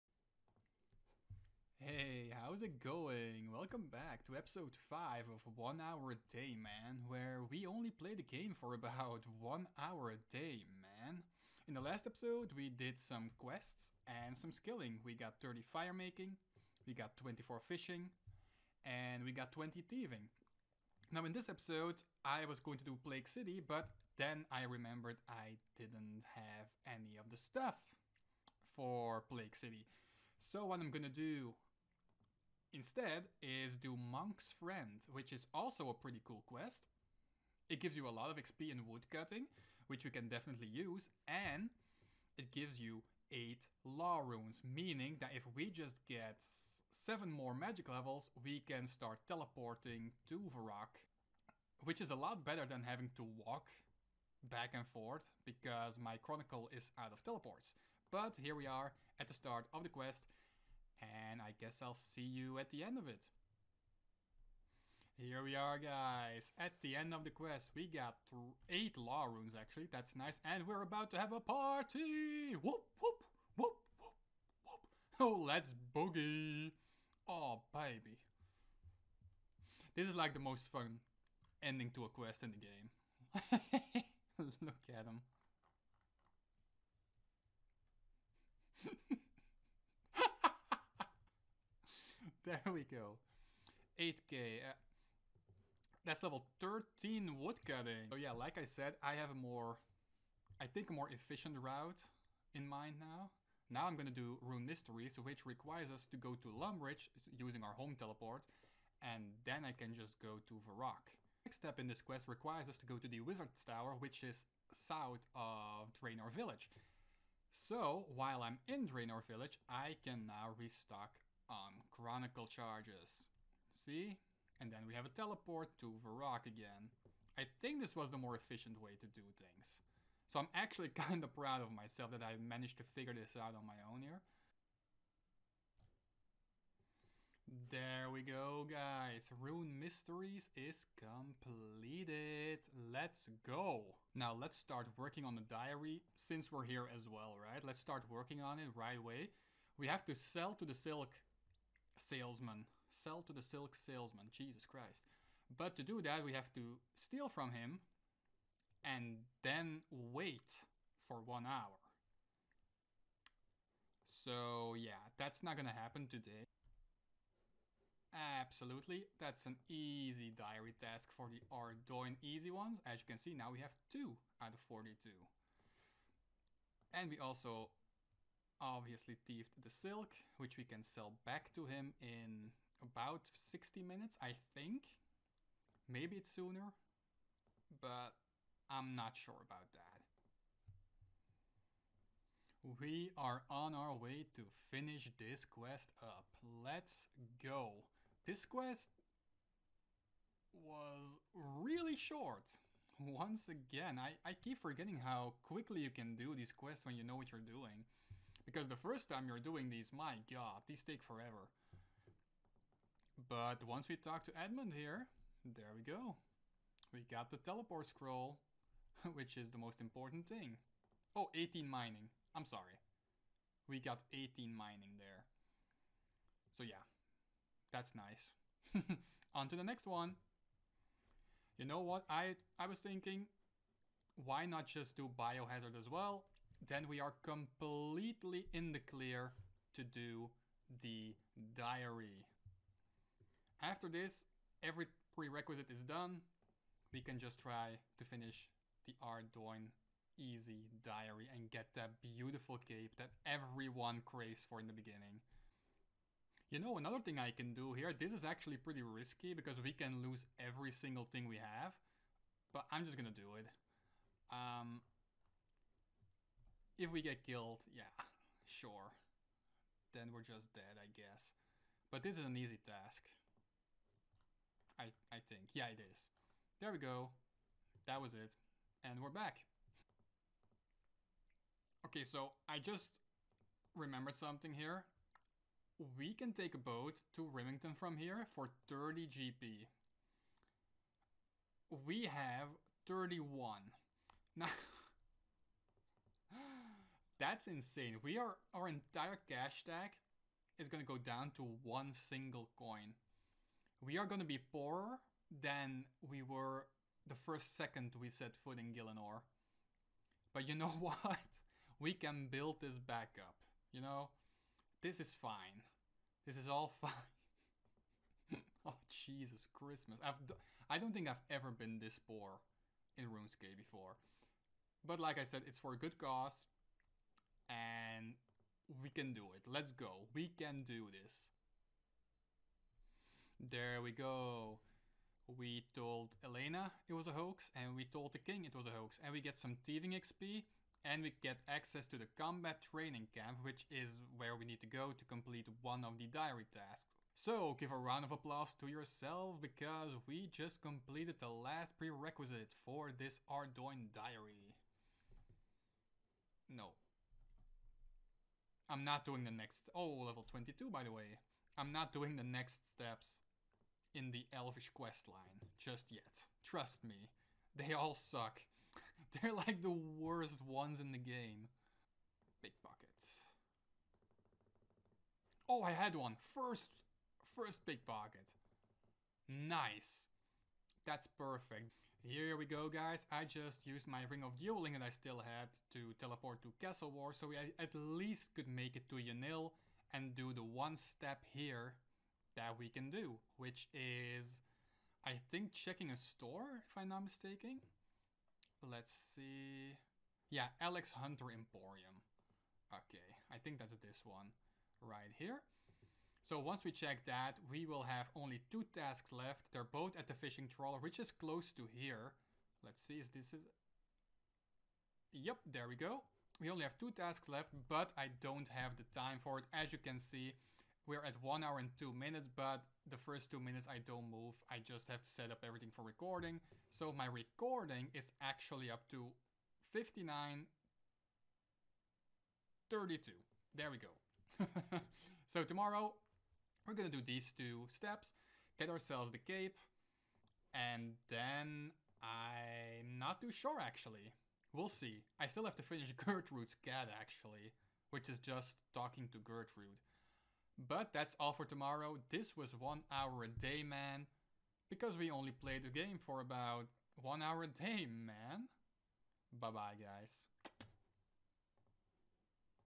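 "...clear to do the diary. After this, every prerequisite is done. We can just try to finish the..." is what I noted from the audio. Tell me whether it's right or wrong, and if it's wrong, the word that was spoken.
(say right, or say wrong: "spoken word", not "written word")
right.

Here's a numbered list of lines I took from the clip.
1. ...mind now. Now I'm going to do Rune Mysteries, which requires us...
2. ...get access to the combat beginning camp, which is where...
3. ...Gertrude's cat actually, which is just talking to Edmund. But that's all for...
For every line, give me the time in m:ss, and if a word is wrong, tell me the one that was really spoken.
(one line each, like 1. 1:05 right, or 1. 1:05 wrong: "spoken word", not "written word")
1. 1:42 right
2. 5:41 wrong: "training", not "beginning"
3. 7:25 wrong: "Gertrude", not "Edmund".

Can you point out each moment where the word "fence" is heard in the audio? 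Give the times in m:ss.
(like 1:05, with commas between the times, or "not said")
not said.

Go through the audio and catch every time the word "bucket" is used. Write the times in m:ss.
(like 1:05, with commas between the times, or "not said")
6:17.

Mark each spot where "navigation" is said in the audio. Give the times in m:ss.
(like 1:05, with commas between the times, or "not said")
not said.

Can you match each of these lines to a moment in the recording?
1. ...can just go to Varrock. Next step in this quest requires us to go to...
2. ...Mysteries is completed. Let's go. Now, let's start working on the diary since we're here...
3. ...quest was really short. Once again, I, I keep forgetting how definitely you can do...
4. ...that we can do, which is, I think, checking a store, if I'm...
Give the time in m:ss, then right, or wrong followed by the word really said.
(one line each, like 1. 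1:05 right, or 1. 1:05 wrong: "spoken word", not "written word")
1. 1:49 right
2. 2:19 right
3. 3:18 wrong: "quickly", not "definitely"
4. 6:32 right.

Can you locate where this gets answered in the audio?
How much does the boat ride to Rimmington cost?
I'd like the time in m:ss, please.
4:48.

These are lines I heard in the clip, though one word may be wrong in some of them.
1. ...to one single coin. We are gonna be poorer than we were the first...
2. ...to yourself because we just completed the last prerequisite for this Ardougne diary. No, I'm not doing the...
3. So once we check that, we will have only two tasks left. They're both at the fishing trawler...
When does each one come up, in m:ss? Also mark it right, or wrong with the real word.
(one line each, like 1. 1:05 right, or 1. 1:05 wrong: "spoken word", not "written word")
1. 5:01 right
2. 5:48 right
3. 6:46 right.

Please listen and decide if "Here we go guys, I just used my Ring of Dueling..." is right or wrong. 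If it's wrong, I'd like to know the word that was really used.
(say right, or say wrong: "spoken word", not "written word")
right.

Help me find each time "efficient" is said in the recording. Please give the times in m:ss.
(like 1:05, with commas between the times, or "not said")
1:41, 2:08.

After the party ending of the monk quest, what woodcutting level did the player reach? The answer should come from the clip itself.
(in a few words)
13.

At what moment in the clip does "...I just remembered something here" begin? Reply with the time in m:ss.
4:42.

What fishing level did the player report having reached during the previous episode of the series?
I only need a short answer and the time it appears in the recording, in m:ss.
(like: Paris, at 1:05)
24, at 0:17.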